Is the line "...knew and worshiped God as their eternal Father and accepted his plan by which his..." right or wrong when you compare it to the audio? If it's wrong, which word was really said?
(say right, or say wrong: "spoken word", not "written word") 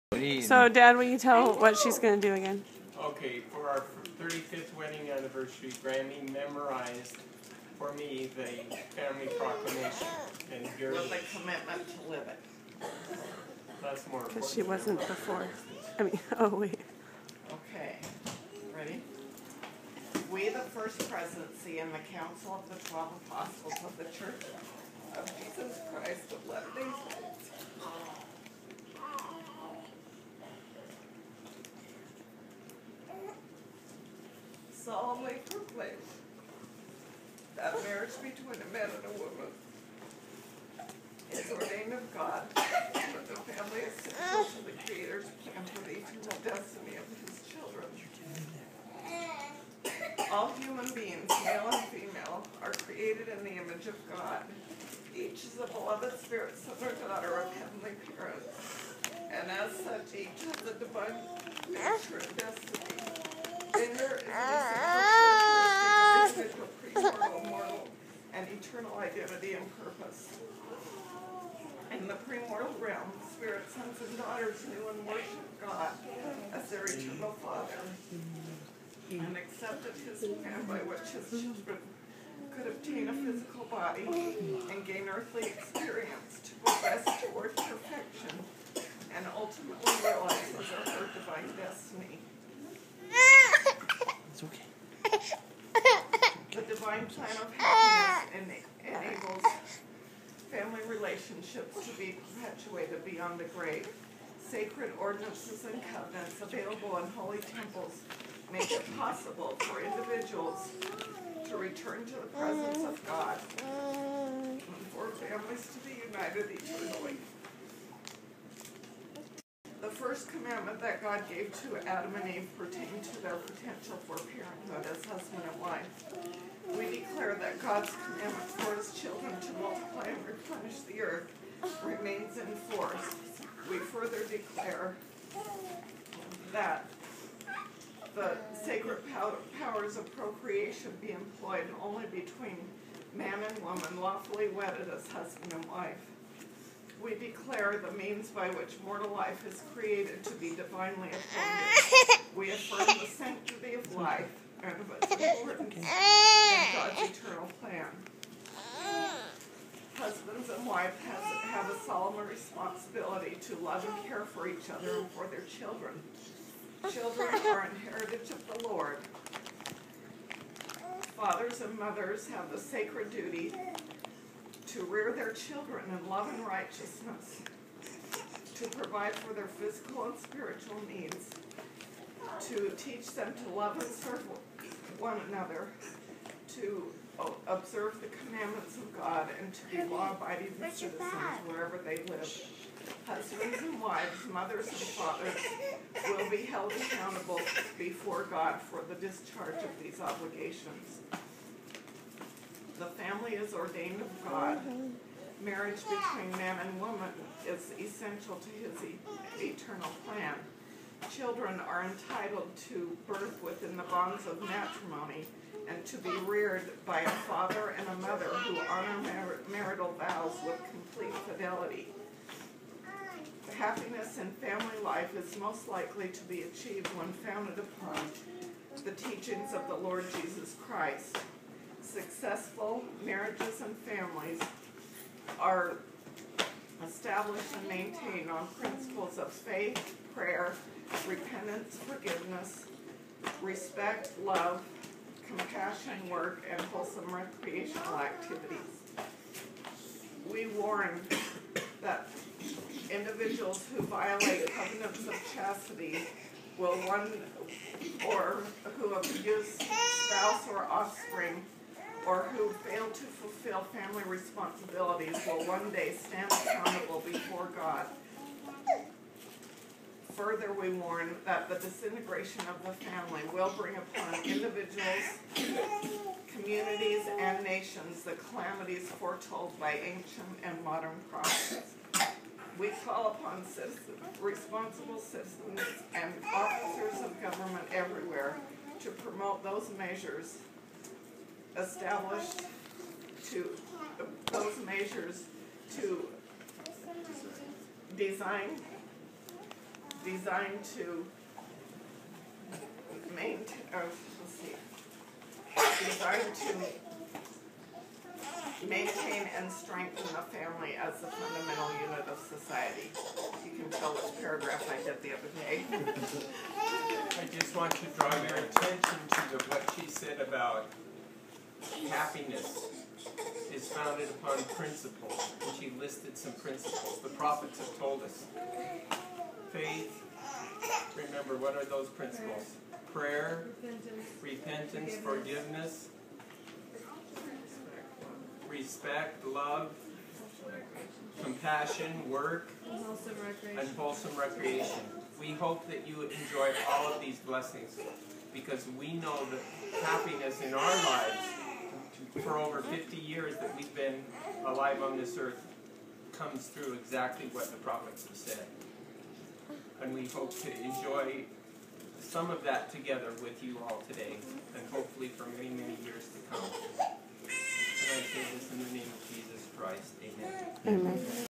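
right.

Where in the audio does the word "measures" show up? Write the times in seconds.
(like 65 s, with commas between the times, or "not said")
289 s, 294 s.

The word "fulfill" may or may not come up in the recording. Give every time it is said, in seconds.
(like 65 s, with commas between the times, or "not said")
263 s.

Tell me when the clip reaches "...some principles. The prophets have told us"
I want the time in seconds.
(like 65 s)
326 s.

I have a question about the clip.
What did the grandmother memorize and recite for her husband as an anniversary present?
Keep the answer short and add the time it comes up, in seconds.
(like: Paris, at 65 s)
the family proclamation, at 8 s.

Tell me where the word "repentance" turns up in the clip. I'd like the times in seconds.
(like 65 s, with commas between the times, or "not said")
241 s, 334 s.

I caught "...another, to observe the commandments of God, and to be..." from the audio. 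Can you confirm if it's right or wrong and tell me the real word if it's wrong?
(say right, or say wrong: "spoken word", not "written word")
right.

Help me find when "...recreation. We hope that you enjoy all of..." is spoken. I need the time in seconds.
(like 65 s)
344 s.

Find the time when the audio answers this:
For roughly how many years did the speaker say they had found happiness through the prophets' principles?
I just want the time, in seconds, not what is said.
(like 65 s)
352 s.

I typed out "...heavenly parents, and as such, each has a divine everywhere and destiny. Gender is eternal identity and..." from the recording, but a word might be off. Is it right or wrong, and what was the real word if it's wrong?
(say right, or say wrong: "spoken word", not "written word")
wrong: "nature", not "everywhere".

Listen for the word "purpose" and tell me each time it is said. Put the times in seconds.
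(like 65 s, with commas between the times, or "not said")
69 s.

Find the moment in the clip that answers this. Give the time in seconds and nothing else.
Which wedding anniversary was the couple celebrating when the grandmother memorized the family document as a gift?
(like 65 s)
4 s.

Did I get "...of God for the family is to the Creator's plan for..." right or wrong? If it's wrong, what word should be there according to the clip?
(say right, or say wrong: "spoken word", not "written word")
right.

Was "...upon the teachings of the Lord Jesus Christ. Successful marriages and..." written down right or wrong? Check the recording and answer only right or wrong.
right.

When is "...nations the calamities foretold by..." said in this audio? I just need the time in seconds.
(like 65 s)
277 s.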